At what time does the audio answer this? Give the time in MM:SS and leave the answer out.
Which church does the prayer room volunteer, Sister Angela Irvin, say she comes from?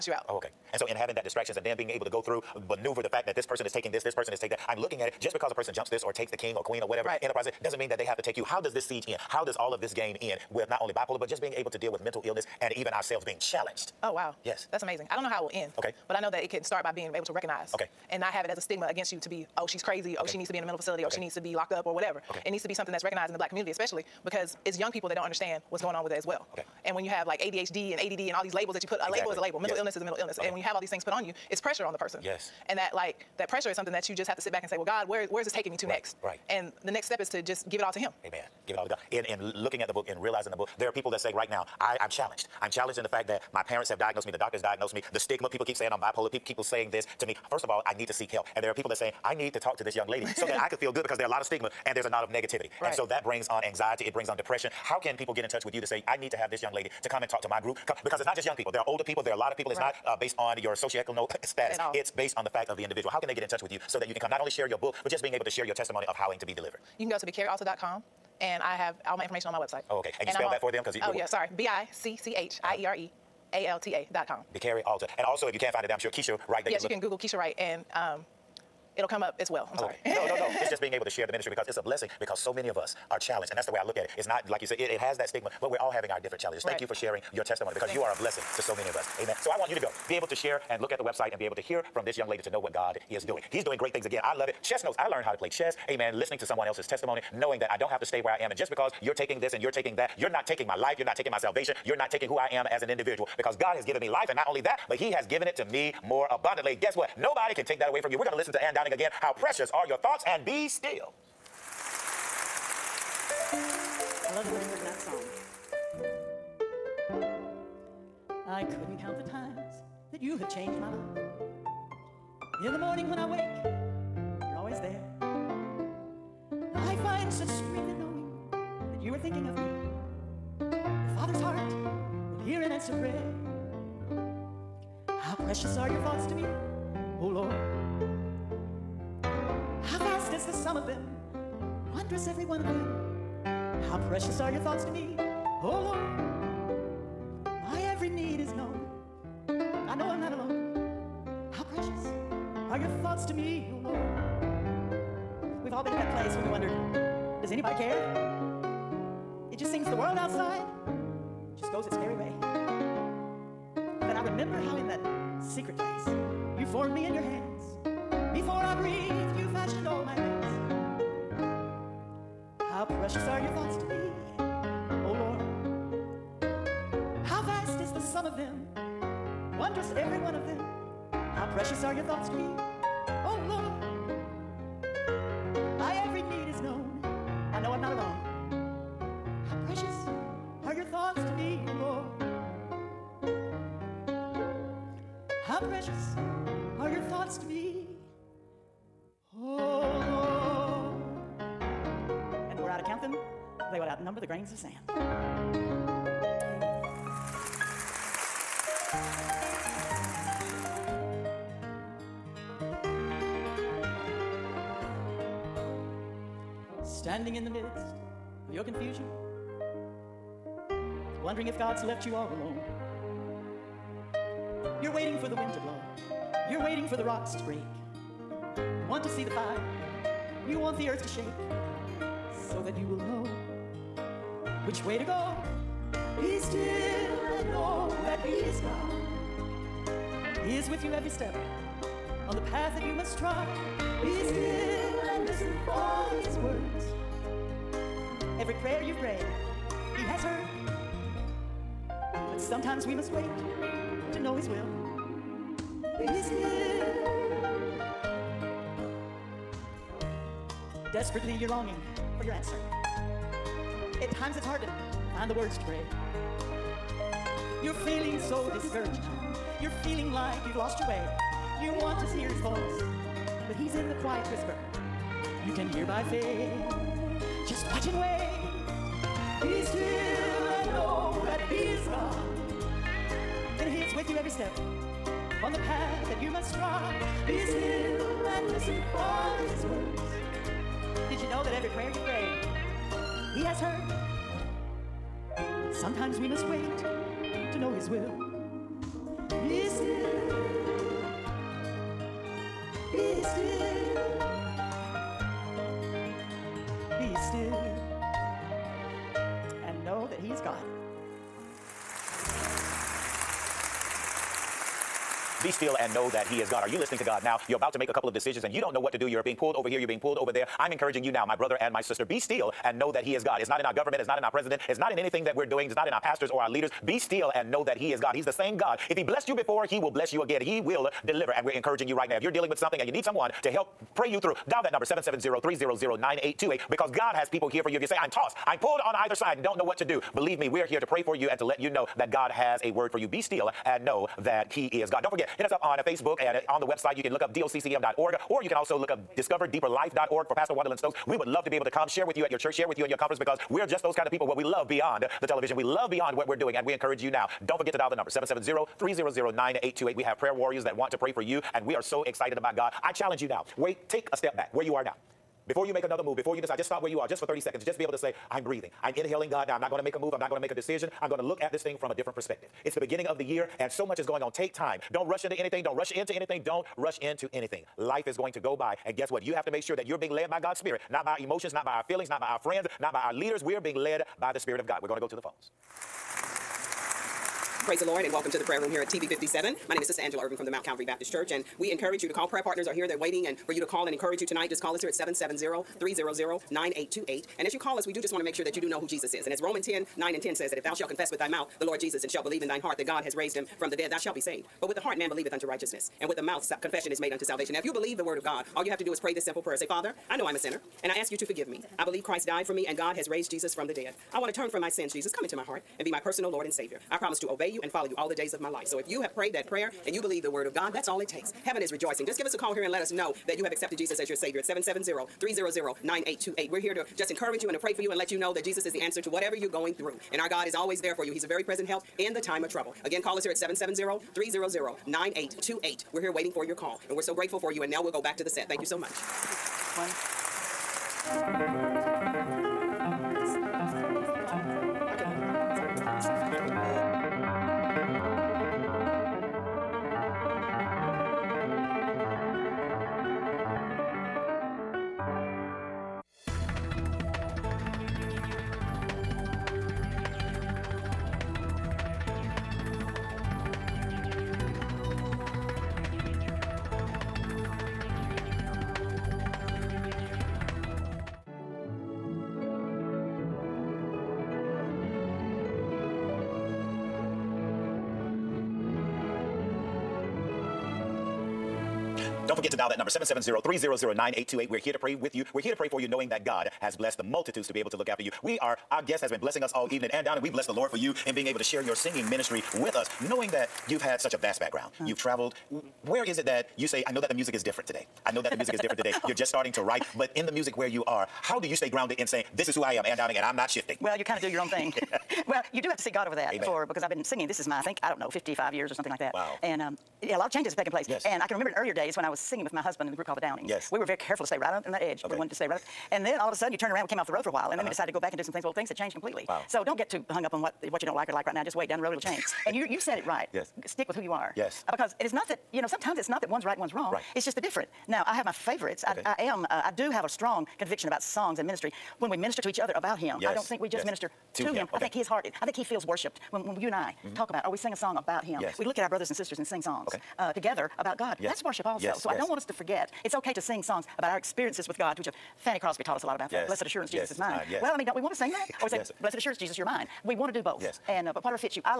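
06:30.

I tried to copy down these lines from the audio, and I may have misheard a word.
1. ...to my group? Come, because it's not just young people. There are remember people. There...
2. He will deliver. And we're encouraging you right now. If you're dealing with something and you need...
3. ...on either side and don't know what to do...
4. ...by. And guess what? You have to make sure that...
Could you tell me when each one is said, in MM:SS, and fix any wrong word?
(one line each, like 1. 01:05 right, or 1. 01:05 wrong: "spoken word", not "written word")
1. 00:57 wrong: "older", not "remember"
2. 05:30 right
3. 05:38 right
4. 06:18 right.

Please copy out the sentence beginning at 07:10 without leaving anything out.
And our God is always there for you.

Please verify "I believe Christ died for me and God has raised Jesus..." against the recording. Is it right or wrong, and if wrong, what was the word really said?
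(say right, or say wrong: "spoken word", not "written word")
right.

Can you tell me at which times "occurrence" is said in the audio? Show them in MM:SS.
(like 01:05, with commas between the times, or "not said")
not said.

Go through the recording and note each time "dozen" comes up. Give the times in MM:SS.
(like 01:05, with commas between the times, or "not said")
not said.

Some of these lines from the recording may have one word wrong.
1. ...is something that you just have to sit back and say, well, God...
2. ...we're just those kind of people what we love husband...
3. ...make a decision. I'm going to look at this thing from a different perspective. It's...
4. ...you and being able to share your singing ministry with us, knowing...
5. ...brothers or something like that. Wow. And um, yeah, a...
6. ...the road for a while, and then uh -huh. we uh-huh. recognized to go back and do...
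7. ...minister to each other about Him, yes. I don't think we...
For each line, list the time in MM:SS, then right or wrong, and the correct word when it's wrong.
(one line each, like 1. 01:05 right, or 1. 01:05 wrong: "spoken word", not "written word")
1. 00:33 right
2. 05:53 wrong: "beyond", not "husband"
3. 06:10 right
4. 08:10 right
5. 08:28 wrong: "years", not "brothers"
6. 08:37 wrong: "decided", not "recognized"
7. 08:52 right.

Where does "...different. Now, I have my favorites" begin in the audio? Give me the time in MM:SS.
08:47.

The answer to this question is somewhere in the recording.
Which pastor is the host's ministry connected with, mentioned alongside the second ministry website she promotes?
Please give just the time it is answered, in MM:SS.
05:50.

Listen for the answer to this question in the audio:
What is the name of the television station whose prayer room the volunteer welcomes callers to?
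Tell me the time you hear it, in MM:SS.
06:28.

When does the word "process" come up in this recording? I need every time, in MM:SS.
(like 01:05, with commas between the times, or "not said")
00:07.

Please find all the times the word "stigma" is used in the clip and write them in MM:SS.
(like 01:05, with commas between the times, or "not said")
00:18, 00:45, 00:51, 01:25.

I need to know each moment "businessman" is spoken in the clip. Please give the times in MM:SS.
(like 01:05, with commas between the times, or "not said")
not said.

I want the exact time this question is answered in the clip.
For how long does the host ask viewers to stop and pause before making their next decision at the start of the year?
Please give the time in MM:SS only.
06:07.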